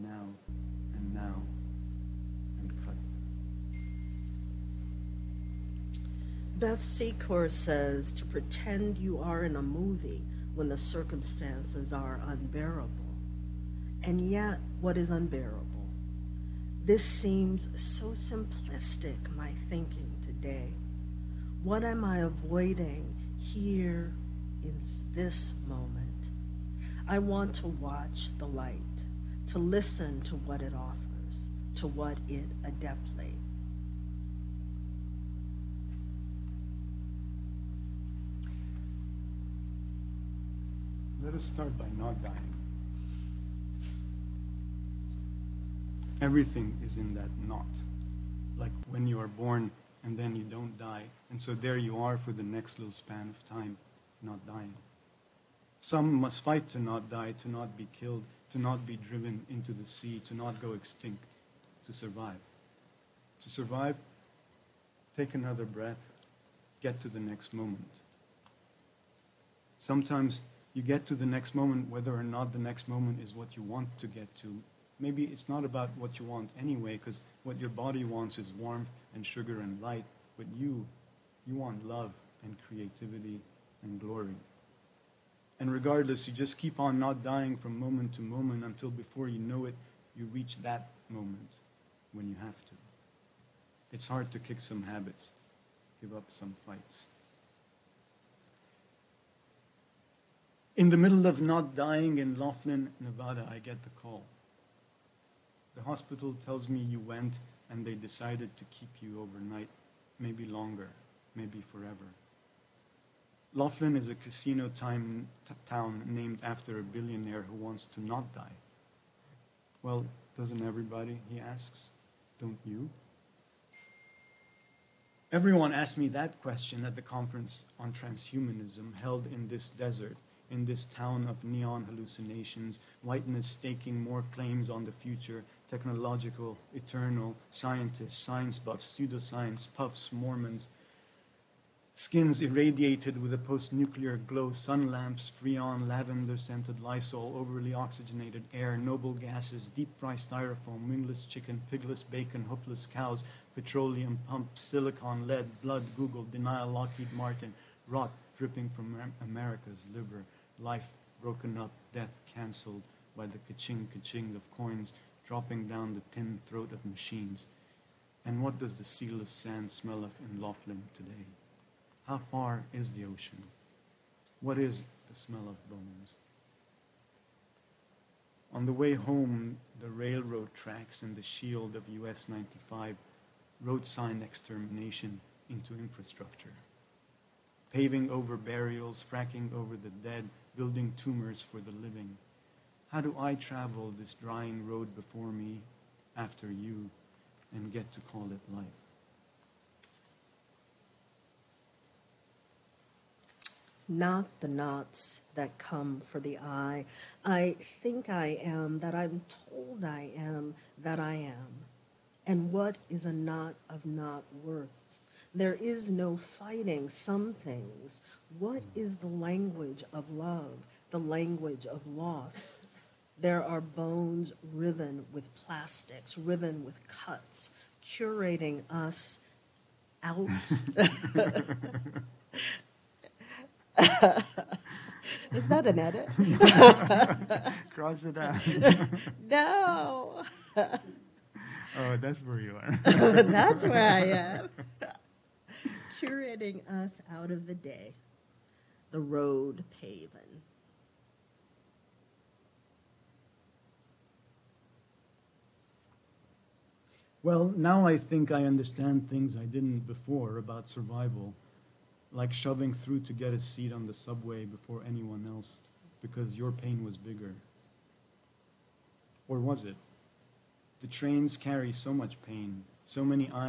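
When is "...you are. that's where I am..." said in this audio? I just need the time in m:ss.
4:02.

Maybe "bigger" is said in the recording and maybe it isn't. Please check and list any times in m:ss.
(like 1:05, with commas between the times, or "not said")
4:26.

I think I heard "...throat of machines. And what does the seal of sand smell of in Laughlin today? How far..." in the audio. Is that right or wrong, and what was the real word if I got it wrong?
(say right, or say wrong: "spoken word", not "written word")
right.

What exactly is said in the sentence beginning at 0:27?
I want to watch the light, to listen to what it offers, to what it adeptly Let us start by not dying.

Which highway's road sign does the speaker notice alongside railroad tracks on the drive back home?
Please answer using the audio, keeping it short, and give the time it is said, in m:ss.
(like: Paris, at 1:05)
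US 95, at 3:02.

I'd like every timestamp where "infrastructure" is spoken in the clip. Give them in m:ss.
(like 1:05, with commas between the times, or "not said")
3:05.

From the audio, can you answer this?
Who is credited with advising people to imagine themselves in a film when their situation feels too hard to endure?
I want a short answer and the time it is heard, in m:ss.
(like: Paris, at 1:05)
Beth Secor, at 0:06.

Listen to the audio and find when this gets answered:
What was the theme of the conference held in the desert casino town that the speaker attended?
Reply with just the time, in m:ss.
2:07.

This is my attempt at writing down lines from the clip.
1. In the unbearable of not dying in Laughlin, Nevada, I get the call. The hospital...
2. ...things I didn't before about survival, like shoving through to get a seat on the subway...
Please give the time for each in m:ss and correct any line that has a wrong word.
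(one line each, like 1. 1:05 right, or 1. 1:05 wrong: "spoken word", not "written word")
1. 1:40 wrong: "middle", not "unbearable"
2. 4:19 right.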